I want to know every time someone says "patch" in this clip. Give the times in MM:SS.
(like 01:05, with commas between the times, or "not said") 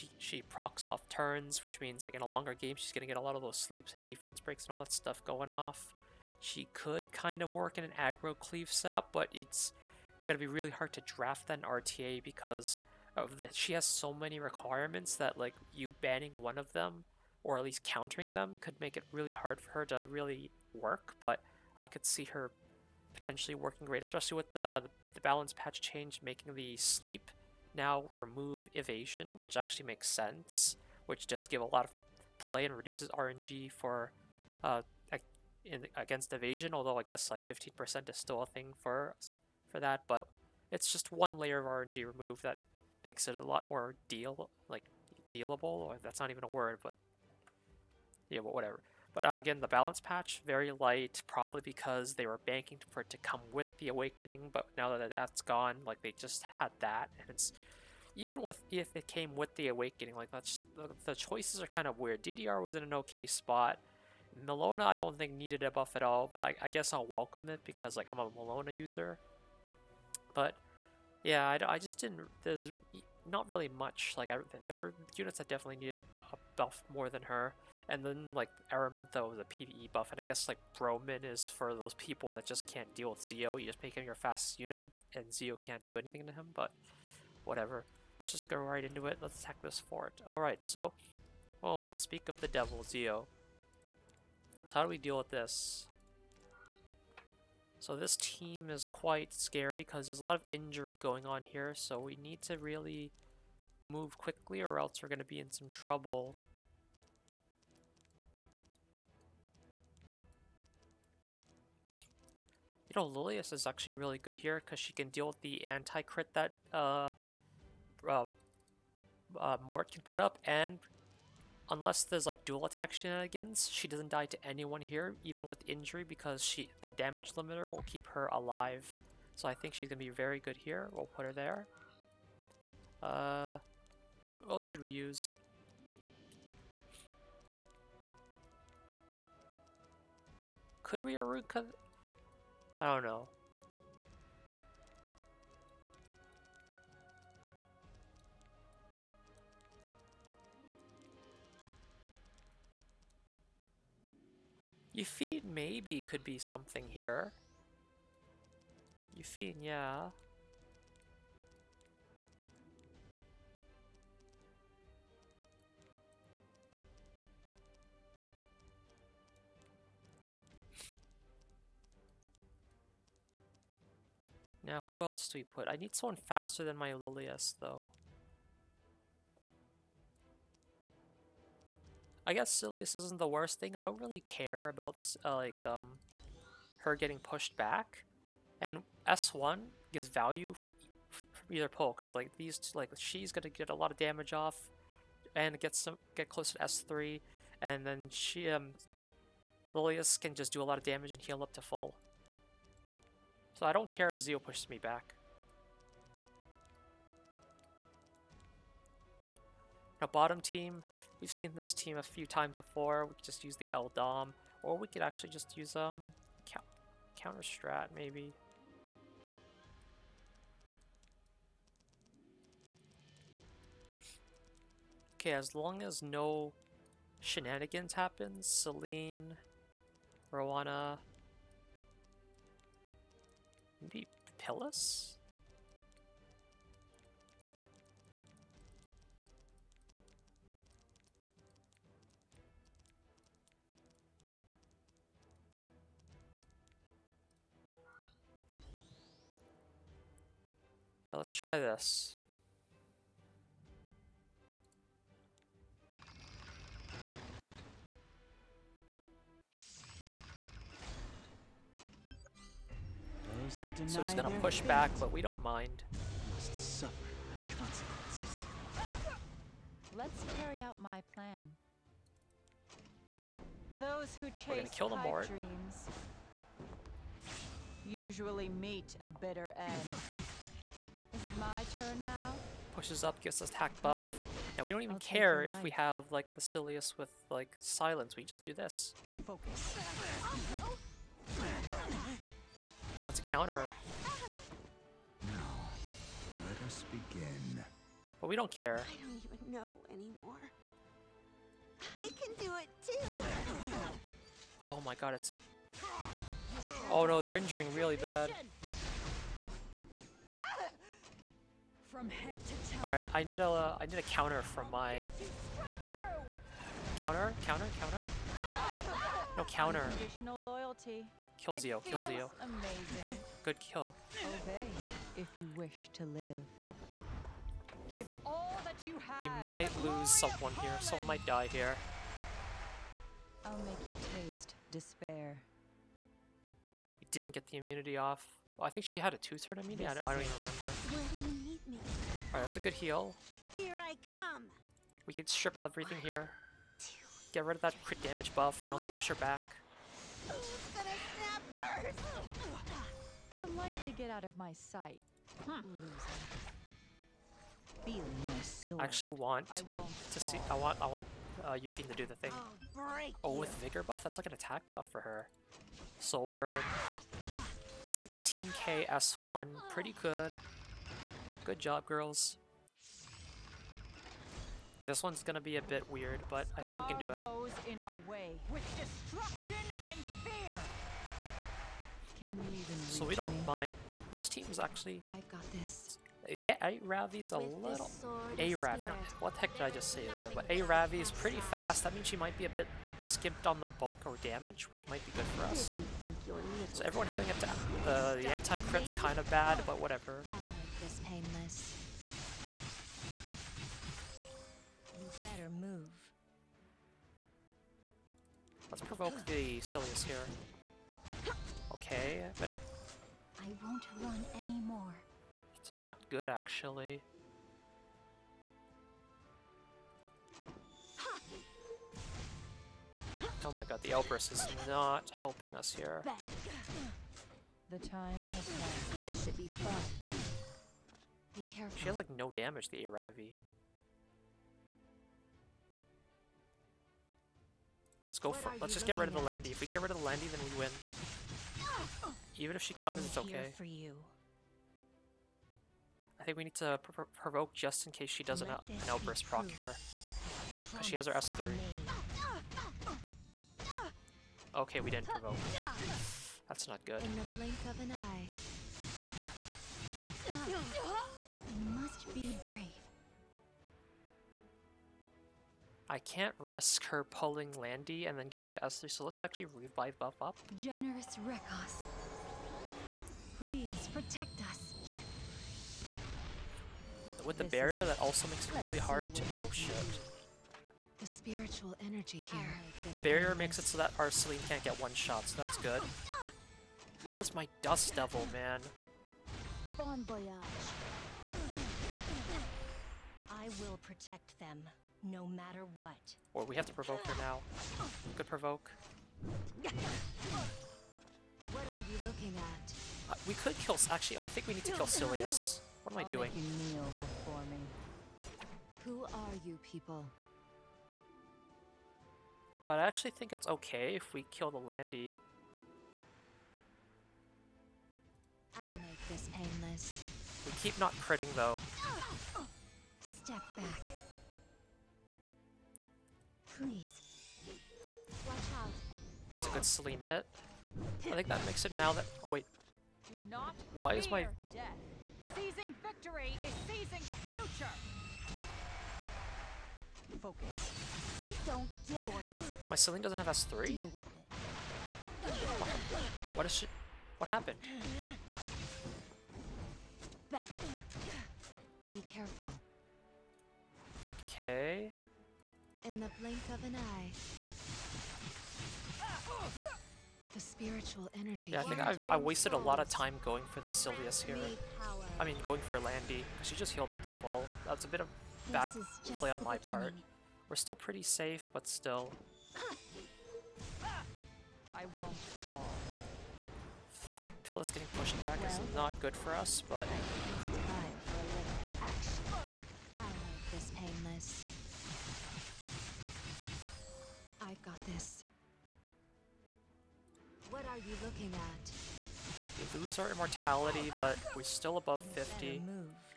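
00:25, 00:50.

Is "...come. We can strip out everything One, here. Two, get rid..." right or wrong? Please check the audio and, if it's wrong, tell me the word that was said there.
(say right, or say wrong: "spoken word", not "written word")
right.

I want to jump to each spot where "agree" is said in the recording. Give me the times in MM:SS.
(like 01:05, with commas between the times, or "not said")
not said.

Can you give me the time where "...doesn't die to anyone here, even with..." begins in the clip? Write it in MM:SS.
02:03.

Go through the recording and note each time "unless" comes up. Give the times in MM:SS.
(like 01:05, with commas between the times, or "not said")
02:01.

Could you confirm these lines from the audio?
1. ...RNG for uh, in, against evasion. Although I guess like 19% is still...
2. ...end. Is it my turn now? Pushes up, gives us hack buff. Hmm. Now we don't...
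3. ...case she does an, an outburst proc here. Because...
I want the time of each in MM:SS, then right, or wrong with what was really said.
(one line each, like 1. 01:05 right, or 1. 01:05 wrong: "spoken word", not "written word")
1. 00:33 wrong: "15", not "19"
2. 04:39 right
3. 07:27 right.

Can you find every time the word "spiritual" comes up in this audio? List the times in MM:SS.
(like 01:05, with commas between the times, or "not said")
08:01, 09:20.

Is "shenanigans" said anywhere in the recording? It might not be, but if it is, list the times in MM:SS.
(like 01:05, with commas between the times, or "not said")
02:02, 03:47.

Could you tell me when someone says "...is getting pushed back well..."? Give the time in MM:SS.
09:37.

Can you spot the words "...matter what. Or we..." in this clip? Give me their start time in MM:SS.
08:15.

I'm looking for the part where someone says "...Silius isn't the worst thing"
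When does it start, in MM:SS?
03:02.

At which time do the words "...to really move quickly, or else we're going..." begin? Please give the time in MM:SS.
01:42.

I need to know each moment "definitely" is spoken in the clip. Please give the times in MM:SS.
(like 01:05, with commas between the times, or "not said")
01:15.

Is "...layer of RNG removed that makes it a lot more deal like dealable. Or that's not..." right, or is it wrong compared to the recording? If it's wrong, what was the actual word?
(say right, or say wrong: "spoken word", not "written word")
right.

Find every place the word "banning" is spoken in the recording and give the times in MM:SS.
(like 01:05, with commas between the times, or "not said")
00:16.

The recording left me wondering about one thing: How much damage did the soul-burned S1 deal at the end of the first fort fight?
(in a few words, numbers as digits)
16k.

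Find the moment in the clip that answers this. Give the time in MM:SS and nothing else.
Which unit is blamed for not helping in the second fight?
07:03.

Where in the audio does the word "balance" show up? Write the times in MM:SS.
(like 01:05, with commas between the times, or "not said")
00:25, 00:49.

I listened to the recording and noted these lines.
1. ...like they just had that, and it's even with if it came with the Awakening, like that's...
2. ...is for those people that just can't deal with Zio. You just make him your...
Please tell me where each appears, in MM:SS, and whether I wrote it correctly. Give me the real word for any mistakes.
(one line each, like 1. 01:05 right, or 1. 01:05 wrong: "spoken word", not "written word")
1. 00:55 right
2. 01:21 right.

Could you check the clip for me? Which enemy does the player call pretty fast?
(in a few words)
A Ravi.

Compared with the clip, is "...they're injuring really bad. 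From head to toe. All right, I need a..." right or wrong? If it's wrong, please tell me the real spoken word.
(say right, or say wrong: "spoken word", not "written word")
right.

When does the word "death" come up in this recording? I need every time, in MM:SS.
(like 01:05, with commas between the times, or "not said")
08:54.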